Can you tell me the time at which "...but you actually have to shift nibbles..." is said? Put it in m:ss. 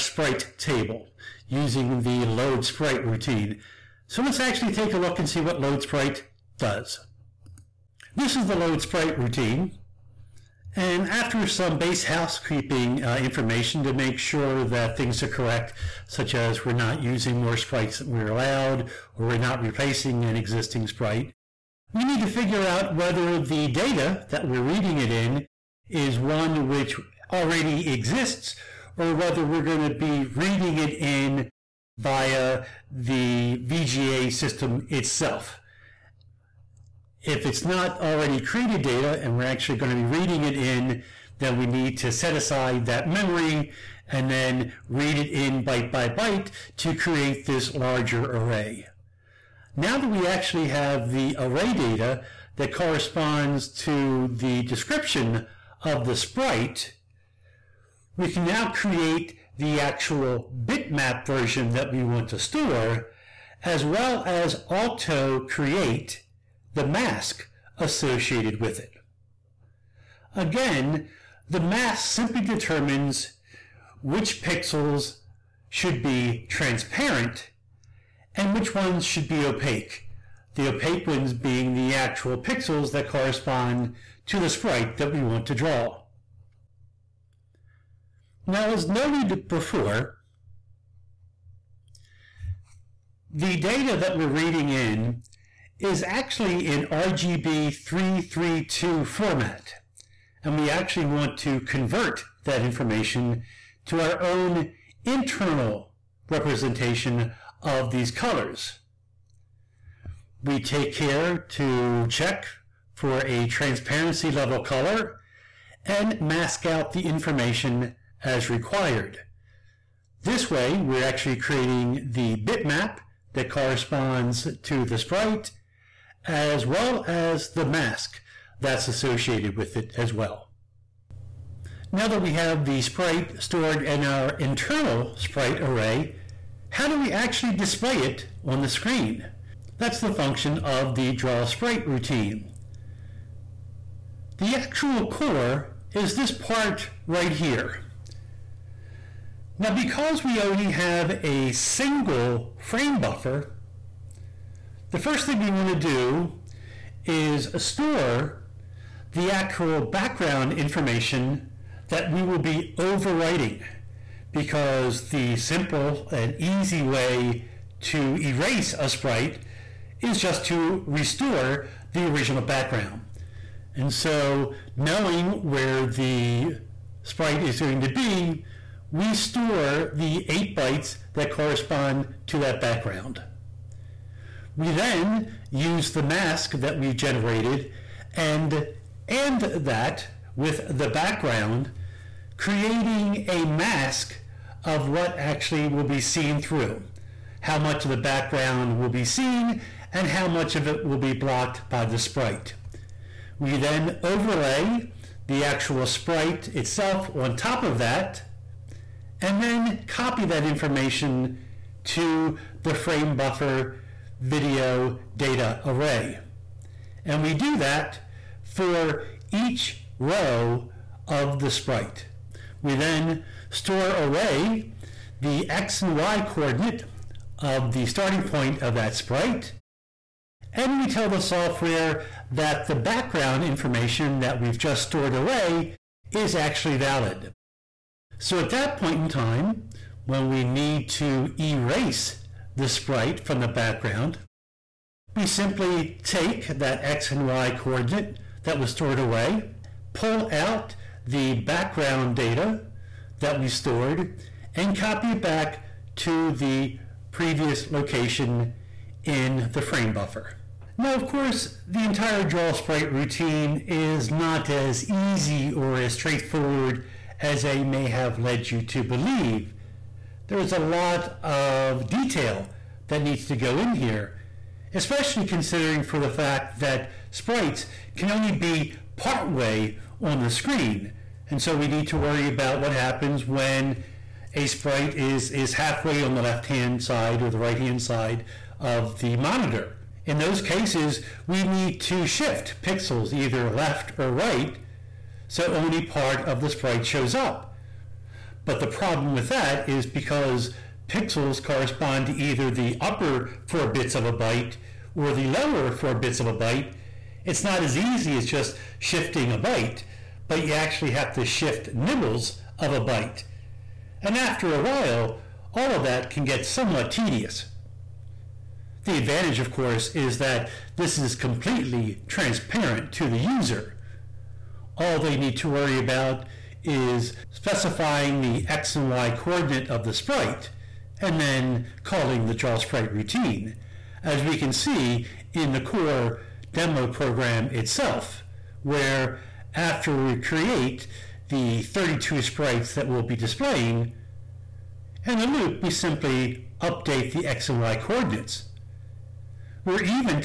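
5:10.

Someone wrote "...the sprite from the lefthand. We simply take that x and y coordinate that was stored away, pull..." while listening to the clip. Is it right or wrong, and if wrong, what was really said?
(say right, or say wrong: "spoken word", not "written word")
wrong: "background", not "lefthand".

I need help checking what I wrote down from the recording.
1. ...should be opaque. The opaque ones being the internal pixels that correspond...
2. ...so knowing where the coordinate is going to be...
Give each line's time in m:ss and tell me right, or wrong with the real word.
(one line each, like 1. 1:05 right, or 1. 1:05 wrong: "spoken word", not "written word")
1. 1:19 wrong: "actual", not "internal"
2. 2:53 wrong: "sprite", not "coordinate".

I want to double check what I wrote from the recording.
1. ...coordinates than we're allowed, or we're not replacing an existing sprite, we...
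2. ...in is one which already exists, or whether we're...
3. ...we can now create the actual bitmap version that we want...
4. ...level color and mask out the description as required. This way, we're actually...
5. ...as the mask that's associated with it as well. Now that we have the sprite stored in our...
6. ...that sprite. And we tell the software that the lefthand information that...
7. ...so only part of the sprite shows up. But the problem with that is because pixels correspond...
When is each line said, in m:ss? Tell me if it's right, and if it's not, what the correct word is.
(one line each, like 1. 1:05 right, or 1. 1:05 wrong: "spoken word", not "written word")
1. 0:17 wrong: "sprites", not "coordinates"
2. 0:25 right
3. 0:58 right
4. 1:54 wrong: "information", not "description"
5. 2:07 right
6. 3:48 wrong: "background", not "lefthand"
7. 4:55 right.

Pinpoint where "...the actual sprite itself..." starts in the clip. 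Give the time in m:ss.
3:25.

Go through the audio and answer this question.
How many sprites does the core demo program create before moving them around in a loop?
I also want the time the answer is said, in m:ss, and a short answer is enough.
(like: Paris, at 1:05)
32, at 5:41.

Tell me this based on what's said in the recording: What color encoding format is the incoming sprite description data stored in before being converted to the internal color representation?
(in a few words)
RGB 332.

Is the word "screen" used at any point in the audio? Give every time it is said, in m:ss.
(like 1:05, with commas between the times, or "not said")
2:18, 4:40.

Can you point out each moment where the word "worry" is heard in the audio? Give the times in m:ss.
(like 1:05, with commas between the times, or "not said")
4:41, 5:25.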